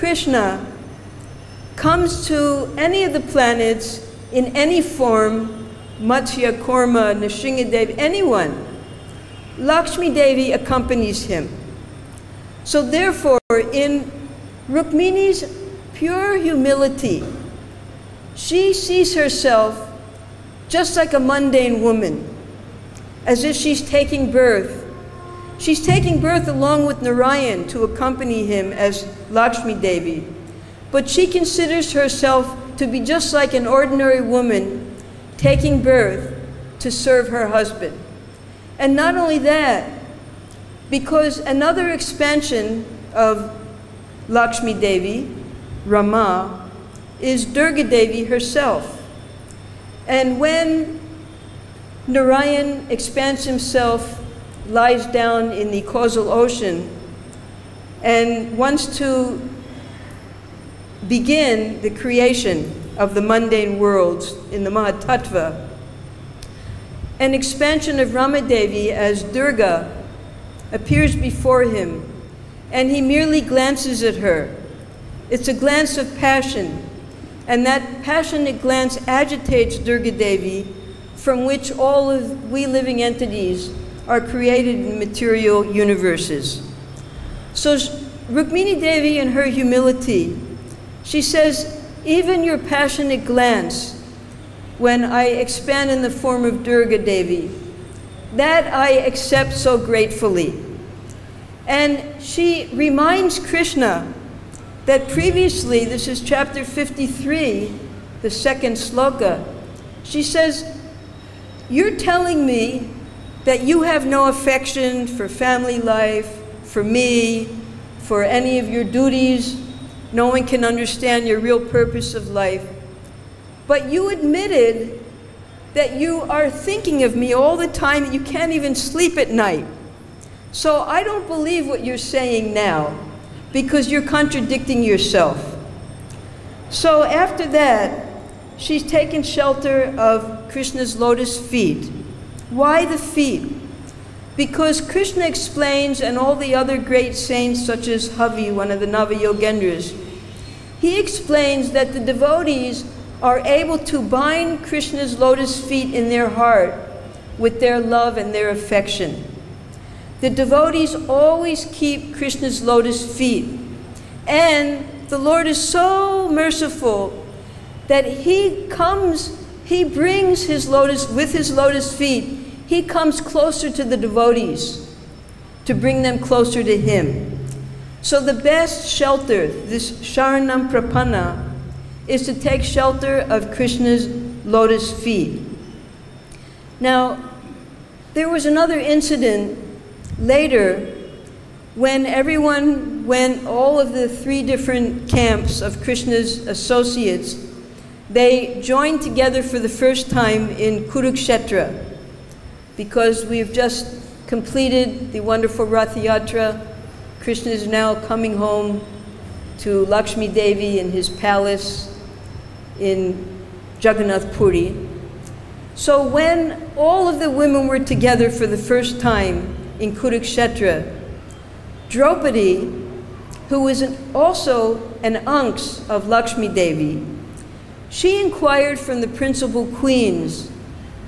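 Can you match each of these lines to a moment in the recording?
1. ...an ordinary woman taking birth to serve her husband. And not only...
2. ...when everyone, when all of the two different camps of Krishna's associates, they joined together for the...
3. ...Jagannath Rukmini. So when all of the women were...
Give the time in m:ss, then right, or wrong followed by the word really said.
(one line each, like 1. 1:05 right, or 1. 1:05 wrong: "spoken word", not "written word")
1. 0:33 right
2. 3:11 wrong: "three", not "two"
3. 3:33 wrong: "Puri", not "Rukmini".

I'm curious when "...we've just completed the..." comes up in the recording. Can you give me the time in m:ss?
3:23.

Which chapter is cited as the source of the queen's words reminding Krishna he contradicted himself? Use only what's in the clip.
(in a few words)
53.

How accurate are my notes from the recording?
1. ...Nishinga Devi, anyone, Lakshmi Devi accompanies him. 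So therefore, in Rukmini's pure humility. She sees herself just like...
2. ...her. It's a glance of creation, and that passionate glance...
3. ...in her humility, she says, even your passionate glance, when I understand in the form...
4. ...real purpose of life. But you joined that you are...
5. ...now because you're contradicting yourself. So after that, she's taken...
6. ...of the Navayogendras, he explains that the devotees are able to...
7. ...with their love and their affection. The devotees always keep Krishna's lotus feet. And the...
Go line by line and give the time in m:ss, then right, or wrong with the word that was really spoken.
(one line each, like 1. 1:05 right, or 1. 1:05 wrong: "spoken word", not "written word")
1. 0:07 right
2. 1:14 wrong: "passion", not "creation"
3. 1:29 wrong: "expand", not "understand"
4. 2:01 wrong: "admitted", not "joined"
5. 2:12 right
6. 2:28 right
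7. 2:37 right.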